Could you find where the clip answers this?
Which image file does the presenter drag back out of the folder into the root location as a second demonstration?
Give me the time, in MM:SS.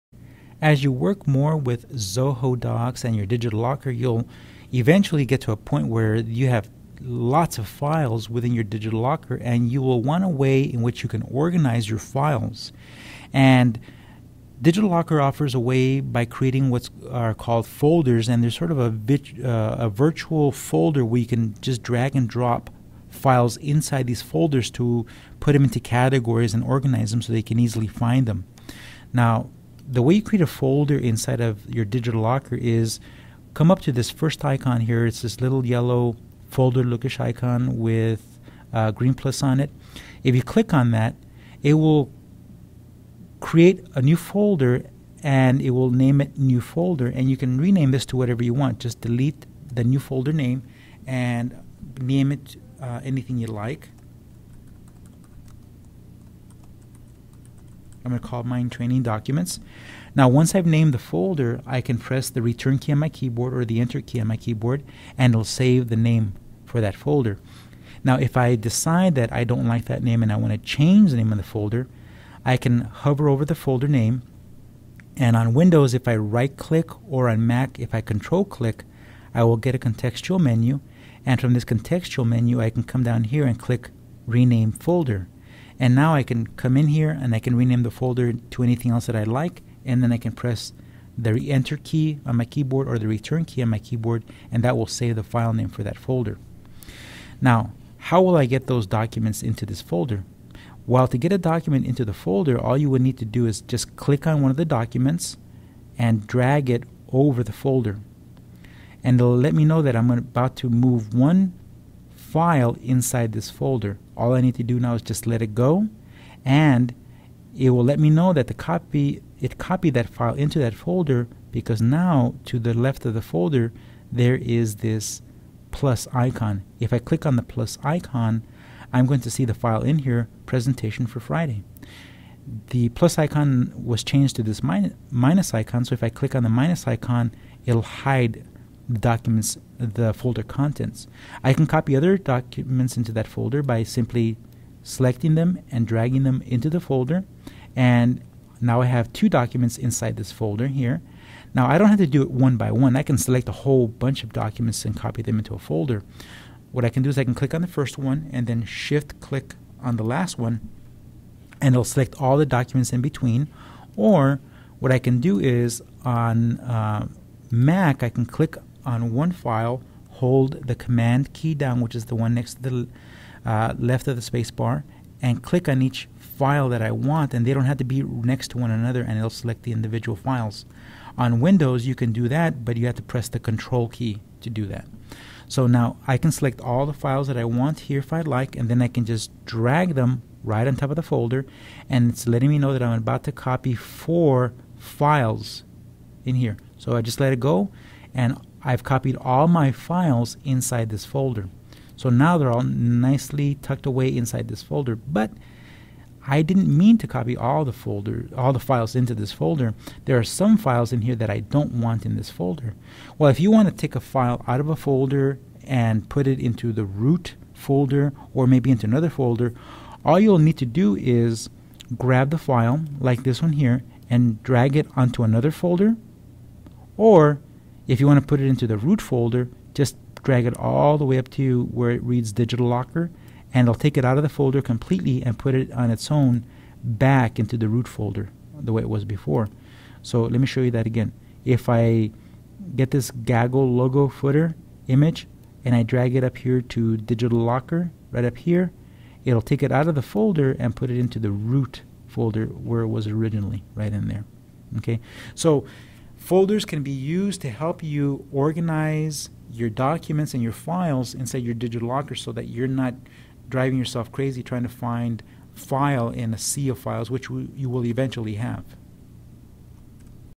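04:03.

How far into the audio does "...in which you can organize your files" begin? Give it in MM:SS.
00:10.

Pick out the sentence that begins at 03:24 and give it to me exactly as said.
But I didn't mean to copy all the folder, all the files into this folder.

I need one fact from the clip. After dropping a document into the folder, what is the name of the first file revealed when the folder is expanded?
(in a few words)
presentation for Friday.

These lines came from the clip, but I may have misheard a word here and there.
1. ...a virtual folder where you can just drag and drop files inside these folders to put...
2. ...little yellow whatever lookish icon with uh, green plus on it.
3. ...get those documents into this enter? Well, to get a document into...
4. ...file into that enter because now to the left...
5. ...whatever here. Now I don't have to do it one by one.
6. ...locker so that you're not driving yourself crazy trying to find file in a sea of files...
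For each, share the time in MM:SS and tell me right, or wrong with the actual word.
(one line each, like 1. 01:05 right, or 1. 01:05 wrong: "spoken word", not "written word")
1. 00:19 right
2. 00:35 wrong: "folder", not "whatever"
3. 01:38 wrong: "folder", not "enter"
4. 02:00 wrong: "folder", not "enter"
5. 02:30 wrong: "folder", not "whatever"
6. 04:21 right.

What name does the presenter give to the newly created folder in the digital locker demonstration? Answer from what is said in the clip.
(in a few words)
training documents.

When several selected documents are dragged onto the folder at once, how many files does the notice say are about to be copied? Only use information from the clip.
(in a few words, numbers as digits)
4.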